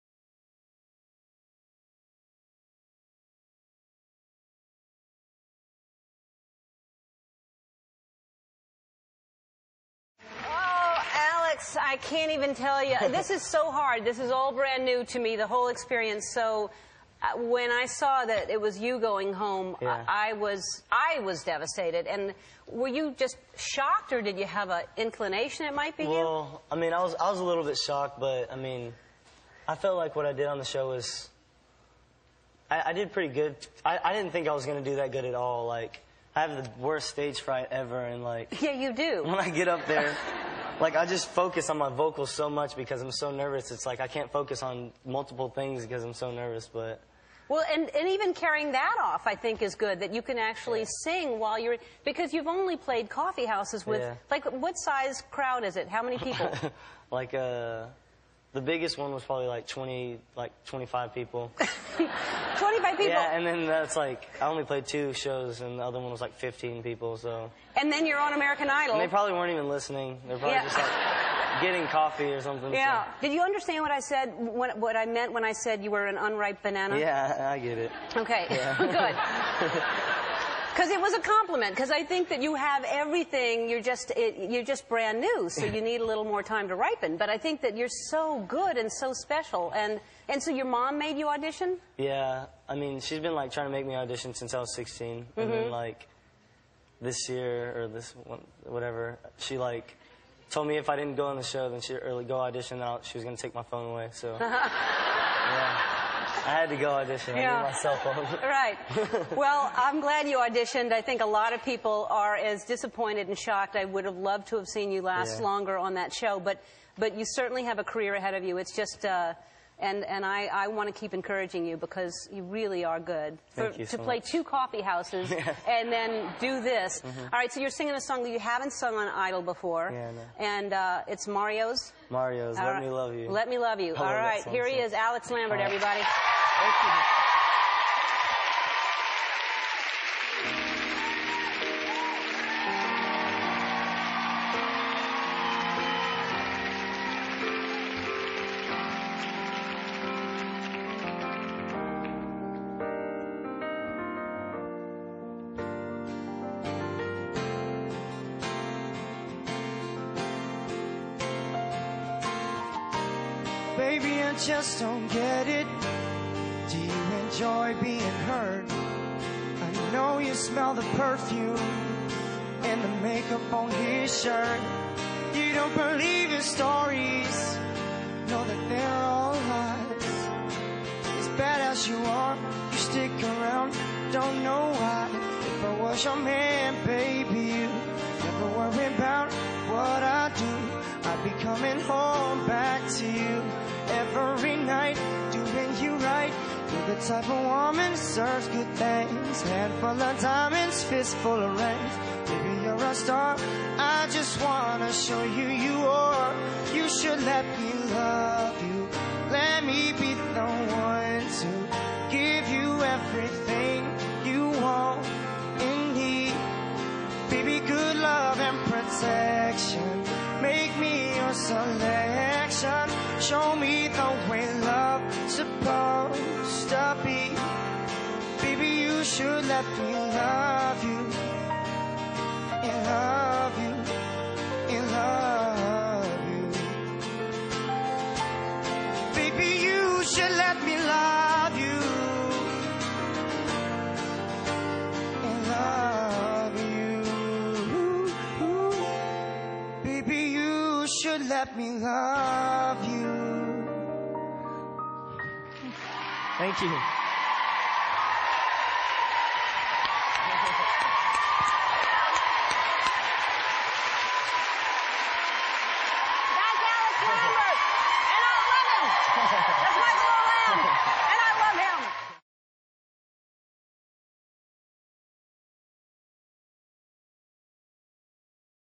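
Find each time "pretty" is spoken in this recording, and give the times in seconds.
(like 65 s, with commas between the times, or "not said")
33 s.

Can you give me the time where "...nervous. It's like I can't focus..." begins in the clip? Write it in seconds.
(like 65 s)
43 s.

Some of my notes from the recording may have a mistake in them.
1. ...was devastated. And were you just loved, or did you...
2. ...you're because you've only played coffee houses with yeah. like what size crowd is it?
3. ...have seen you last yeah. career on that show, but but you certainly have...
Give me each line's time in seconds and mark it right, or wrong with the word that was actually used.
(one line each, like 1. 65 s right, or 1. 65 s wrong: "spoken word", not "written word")
1. 21 s wrong: "shocked", not "loved"
2. 51 s right
3. 114 s wrong: "longer", not "career".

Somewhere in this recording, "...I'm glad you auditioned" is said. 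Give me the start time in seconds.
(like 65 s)
109 s.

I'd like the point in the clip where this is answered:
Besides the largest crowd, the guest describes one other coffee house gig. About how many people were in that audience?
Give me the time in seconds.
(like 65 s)
66 s.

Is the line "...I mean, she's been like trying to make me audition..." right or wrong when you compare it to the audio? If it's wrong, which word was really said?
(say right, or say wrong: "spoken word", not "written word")
right.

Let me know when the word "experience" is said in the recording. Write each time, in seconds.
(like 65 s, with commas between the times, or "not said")
15 s.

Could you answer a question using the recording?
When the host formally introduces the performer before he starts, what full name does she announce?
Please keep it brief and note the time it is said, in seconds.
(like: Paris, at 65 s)
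Alex Lambert, at 134 s.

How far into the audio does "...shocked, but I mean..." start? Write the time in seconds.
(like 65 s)
27 s.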